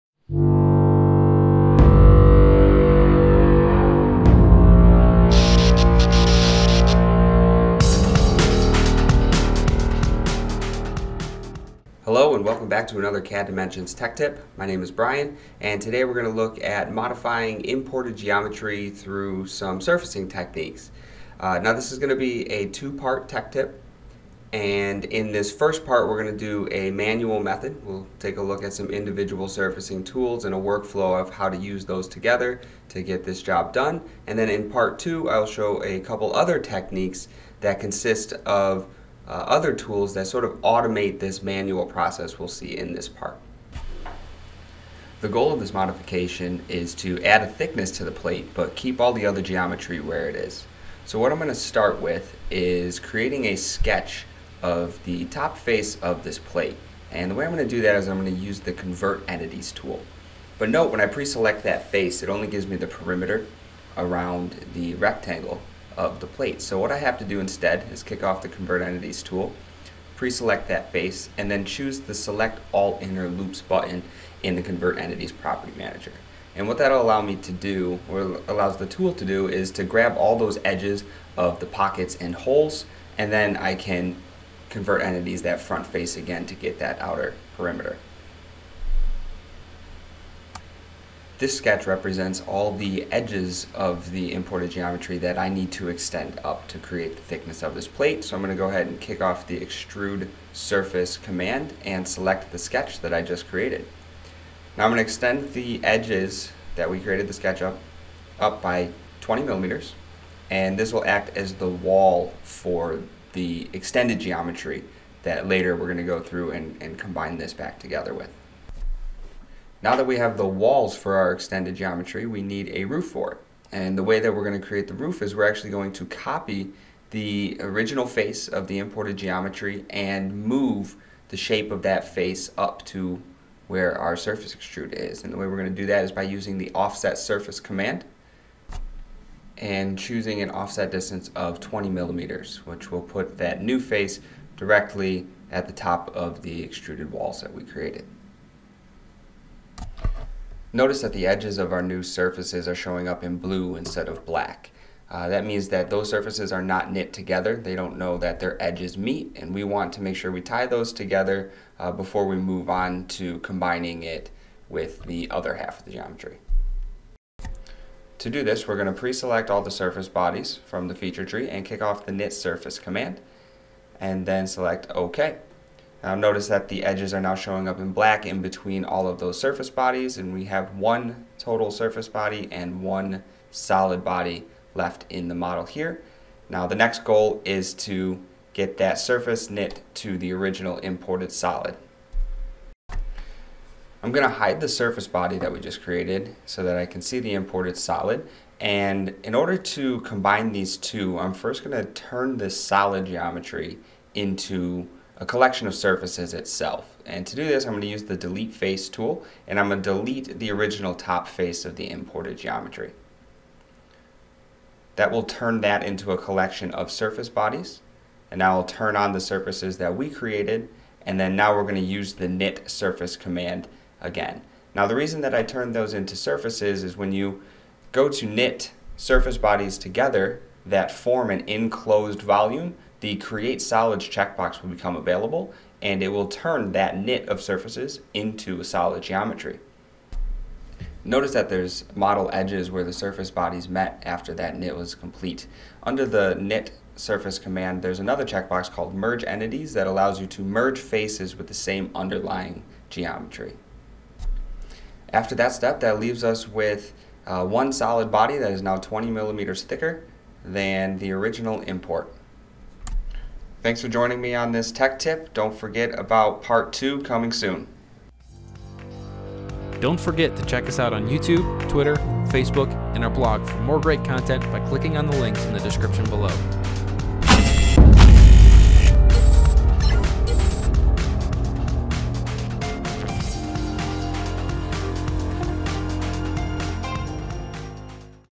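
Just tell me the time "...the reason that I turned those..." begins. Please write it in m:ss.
3:44.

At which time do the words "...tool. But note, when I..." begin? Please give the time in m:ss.
0:59.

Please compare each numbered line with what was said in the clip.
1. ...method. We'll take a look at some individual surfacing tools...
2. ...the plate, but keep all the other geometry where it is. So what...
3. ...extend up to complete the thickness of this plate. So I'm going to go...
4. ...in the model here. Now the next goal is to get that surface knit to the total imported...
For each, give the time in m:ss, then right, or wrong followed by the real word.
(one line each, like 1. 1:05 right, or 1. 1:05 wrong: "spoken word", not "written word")
1. 0:27 right
2. 0:48 right
3. 1:35 wrong: "create", not "complete"
4. 3:05 wrong: "original", not "total".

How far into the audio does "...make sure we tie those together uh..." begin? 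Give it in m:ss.
2:40.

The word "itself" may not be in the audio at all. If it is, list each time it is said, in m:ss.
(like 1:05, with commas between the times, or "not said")
3:26.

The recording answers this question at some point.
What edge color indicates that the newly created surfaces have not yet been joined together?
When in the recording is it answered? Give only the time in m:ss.
2:33.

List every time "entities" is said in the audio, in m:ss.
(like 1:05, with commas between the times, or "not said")
0:59, 1:08, 1:14, 1:25, 4:09.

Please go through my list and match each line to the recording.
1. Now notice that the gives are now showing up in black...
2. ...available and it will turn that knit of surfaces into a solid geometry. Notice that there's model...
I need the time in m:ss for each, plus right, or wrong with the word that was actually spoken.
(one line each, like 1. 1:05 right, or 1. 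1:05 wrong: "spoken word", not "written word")
1. 2:56 wrong: "edges", not "gives"
2. 3:54 right.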